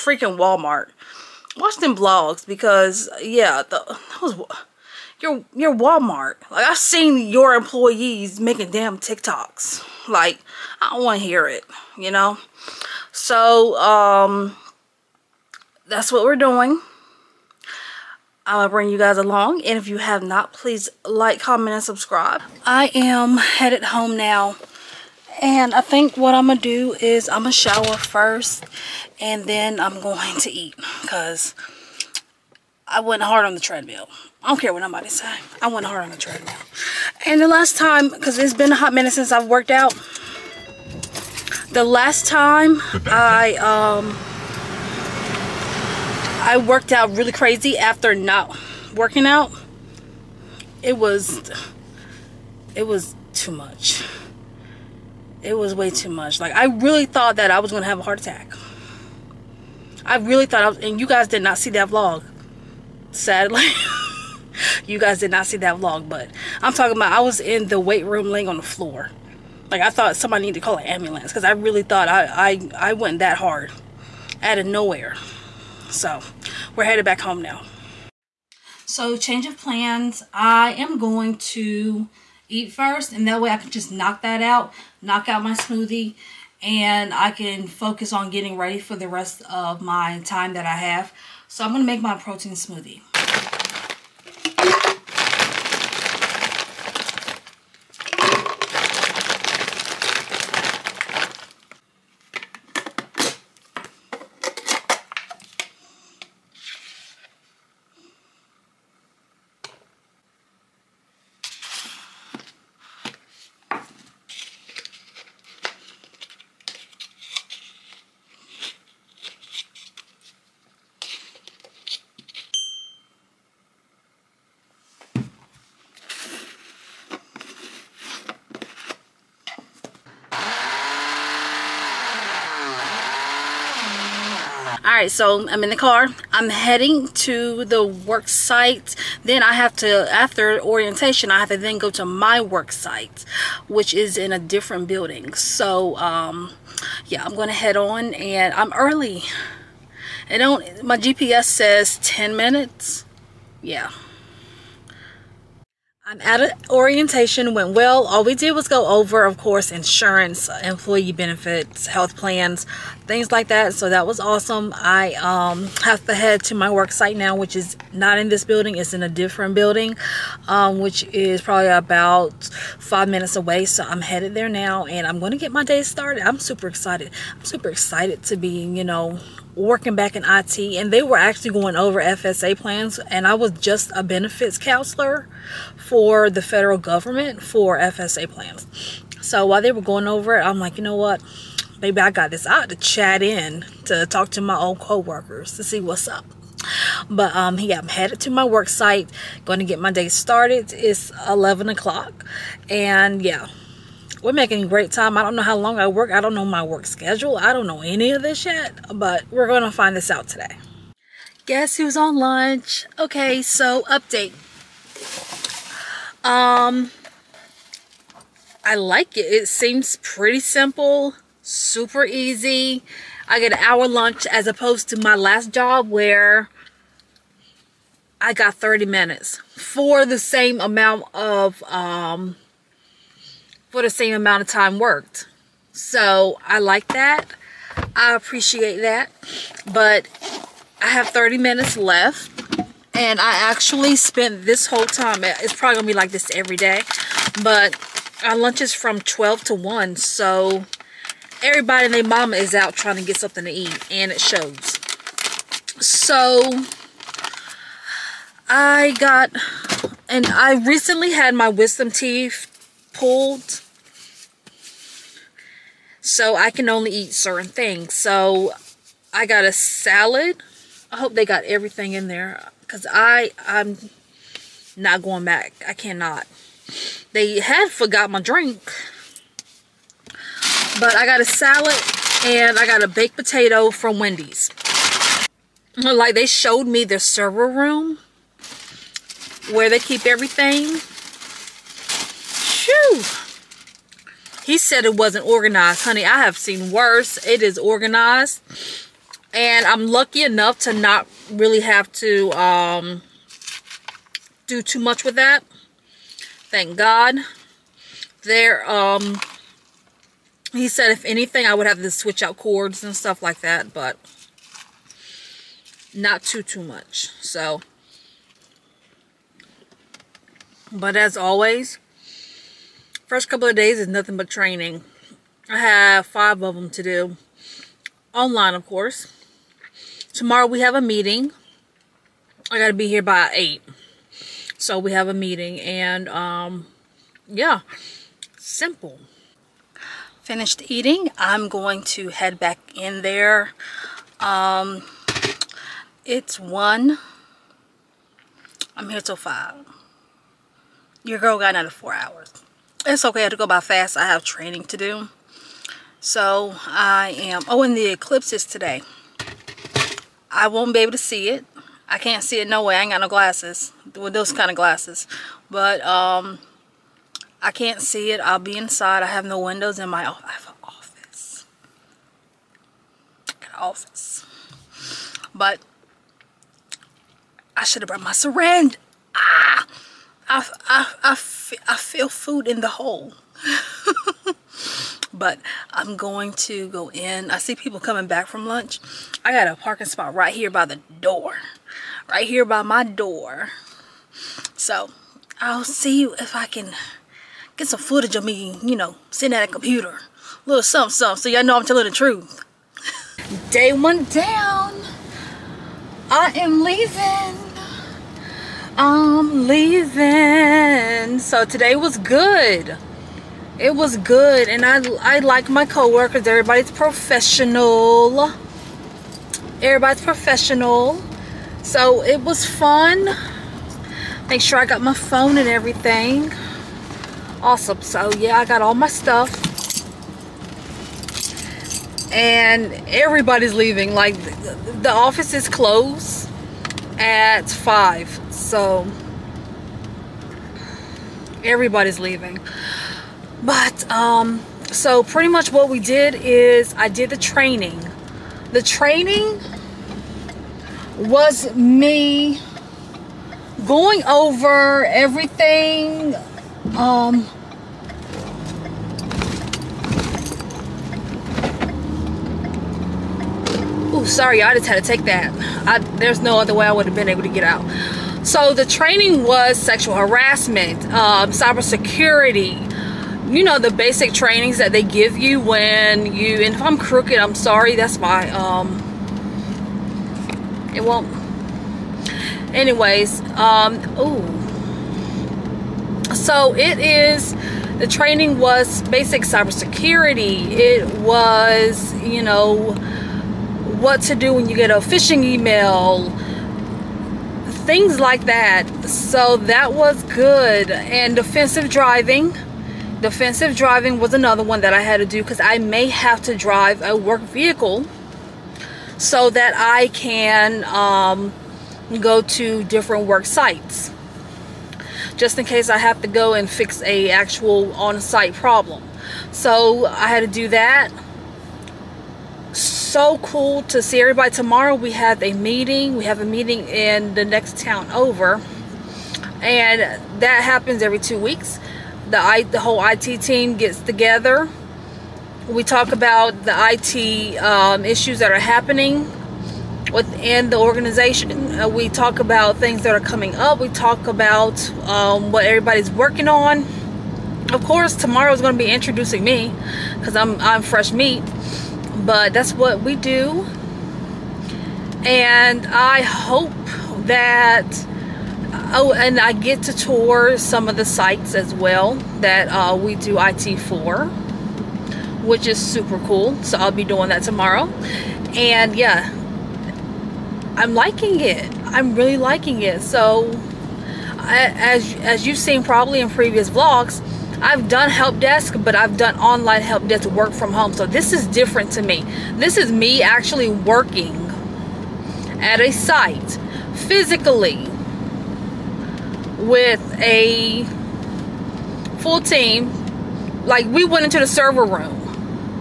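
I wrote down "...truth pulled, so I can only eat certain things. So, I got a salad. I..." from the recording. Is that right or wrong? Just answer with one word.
wrong.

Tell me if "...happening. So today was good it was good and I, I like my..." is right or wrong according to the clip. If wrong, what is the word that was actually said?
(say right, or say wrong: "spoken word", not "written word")
wrong: "leaving", not "happening".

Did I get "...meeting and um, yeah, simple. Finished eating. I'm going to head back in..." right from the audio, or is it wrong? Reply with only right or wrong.
right.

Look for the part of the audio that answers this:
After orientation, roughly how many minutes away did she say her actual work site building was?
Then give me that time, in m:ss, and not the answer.
2:51.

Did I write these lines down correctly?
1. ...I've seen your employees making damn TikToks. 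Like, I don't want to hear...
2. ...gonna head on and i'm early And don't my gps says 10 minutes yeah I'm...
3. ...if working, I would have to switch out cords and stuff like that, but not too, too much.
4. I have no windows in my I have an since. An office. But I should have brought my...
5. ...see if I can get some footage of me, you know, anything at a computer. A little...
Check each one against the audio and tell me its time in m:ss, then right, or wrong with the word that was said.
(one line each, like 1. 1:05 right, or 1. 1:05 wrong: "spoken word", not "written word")
1. 0:06 right
2. 2:27 right
3. 5:10 wrong: "anything", not "working"
4. 6:09 wrong: "office", not "since"
5. 6:35 wrong: "sitting", not "anything".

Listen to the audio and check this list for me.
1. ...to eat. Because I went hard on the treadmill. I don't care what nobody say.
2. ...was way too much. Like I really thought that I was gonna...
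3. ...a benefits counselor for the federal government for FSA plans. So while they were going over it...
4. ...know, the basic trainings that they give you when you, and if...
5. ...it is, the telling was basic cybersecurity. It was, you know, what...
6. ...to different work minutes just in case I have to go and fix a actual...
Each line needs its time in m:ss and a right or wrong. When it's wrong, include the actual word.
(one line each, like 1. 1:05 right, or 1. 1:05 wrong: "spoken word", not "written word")
1. 0:30 right
2. 0:55 right
3. 3:03 right
4. 7:53 right
5. 8:06 wrong: "training", not "telling"
6. 8:32 wrong: "sites", not "minutes".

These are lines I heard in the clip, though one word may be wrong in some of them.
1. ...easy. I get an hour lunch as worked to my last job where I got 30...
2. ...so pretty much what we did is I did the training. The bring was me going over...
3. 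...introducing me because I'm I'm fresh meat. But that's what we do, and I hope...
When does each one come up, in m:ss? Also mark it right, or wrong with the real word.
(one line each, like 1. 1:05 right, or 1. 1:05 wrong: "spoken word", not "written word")
1. 3:42 wrong: "opposed", not "worked"
2. 7:24 wrong: "training", not "bring"
3. 9:08 right.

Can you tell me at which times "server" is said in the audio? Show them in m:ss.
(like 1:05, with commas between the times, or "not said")
4:46, 9:54.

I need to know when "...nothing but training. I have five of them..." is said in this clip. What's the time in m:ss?
5:23.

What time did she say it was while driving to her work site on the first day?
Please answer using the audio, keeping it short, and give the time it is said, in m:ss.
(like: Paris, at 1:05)
11 o'clock, at 3:21.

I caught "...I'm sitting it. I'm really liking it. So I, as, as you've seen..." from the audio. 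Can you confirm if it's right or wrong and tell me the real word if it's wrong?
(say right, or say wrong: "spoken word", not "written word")
wrong: "liking", not "sitting".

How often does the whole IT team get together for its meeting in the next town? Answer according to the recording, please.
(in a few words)
Every two weeks.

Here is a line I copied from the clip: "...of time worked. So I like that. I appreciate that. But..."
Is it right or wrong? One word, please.
right.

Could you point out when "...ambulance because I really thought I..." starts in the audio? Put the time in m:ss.
1:10.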